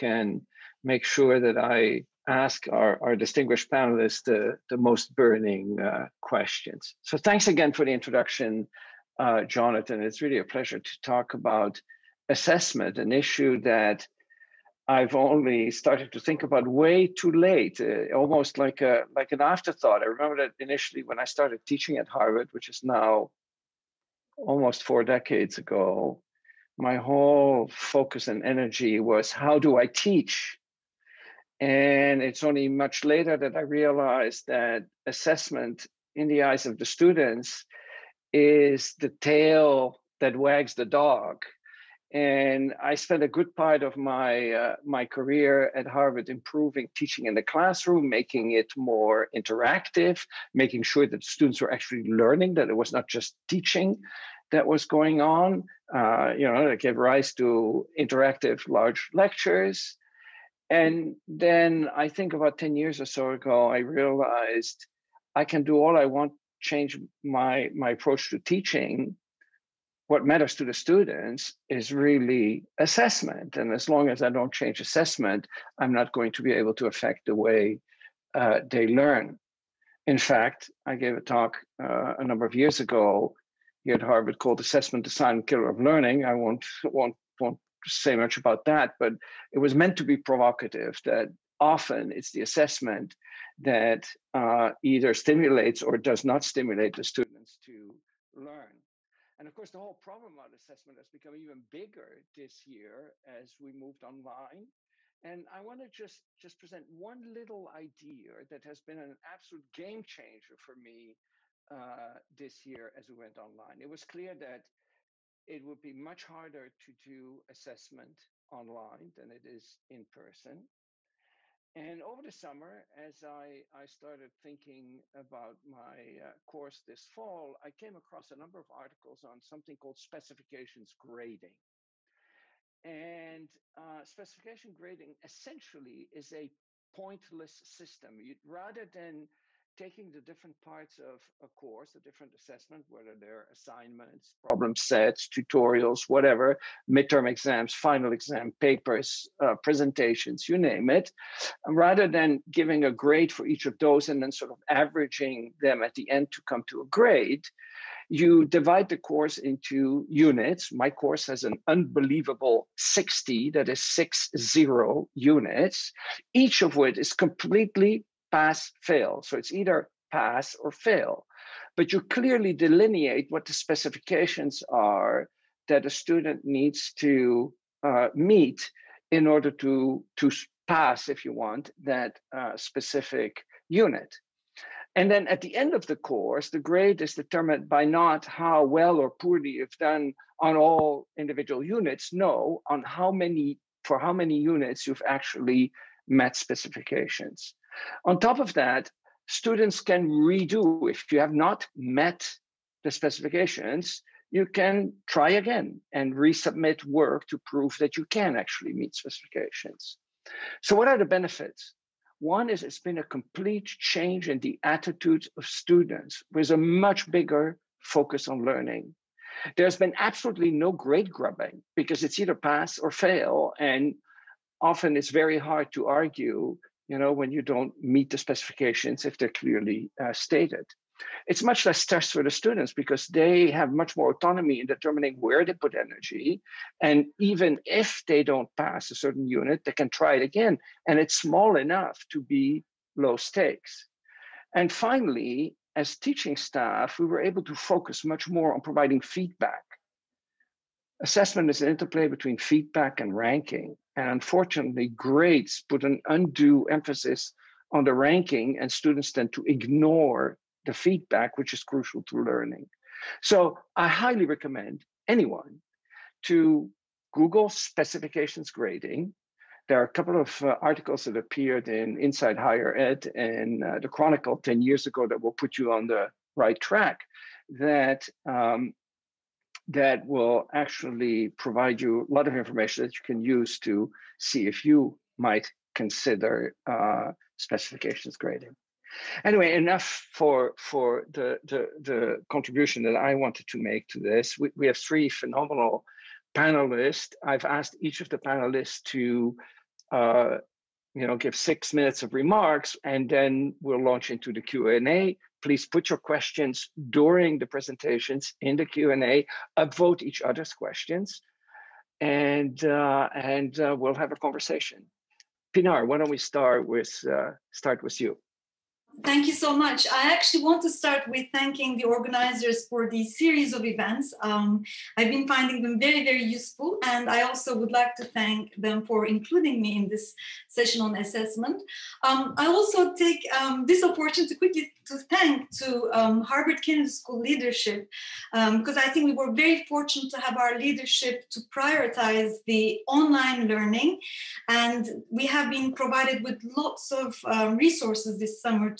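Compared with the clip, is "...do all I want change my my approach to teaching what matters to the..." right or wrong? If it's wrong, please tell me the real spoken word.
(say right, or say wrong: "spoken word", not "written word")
right.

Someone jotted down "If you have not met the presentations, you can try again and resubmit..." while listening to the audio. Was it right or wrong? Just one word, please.
wrong.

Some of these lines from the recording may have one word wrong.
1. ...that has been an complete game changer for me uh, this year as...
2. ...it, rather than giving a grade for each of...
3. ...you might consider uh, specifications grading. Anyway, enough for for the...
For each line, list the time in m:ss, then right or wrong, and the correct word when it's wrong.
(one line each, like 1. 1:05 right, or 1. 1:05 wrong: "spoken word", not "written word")
1. 1:48 wrong: "absolute", not "complete"
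2. 2:30 right
3. 4:44 right.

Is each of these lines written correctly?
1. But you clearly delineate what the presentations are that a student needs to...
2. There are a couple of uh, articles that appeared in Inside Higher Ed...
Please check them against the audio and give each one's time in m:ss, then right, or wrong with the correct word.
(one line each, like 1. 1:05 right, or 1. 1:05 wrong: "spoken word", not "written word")
1. 2:51 wrong: "specifications", not "presentations"
2. 4:29 right.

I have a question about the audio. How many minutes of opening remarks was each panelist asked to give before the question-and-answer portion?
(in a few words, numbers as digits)
6.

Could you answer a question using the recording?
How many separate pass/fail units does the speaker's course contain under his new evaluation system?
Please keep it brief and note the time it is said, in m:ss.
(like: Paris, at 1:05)
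60, at 2:42.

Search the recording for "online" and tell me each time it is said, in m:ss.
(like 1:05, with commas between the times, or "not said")
1:44, 1:53, 1:58, 5:42.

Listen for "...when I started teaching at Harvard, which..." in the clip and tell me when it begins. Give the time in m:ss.
0:21.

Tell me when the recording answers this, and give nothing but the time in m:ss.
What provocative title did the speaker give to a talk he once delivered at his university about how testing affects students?
1:24.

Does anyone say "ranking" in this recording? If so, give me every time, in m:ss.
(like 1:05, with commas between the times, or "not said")
4:13, 4:17.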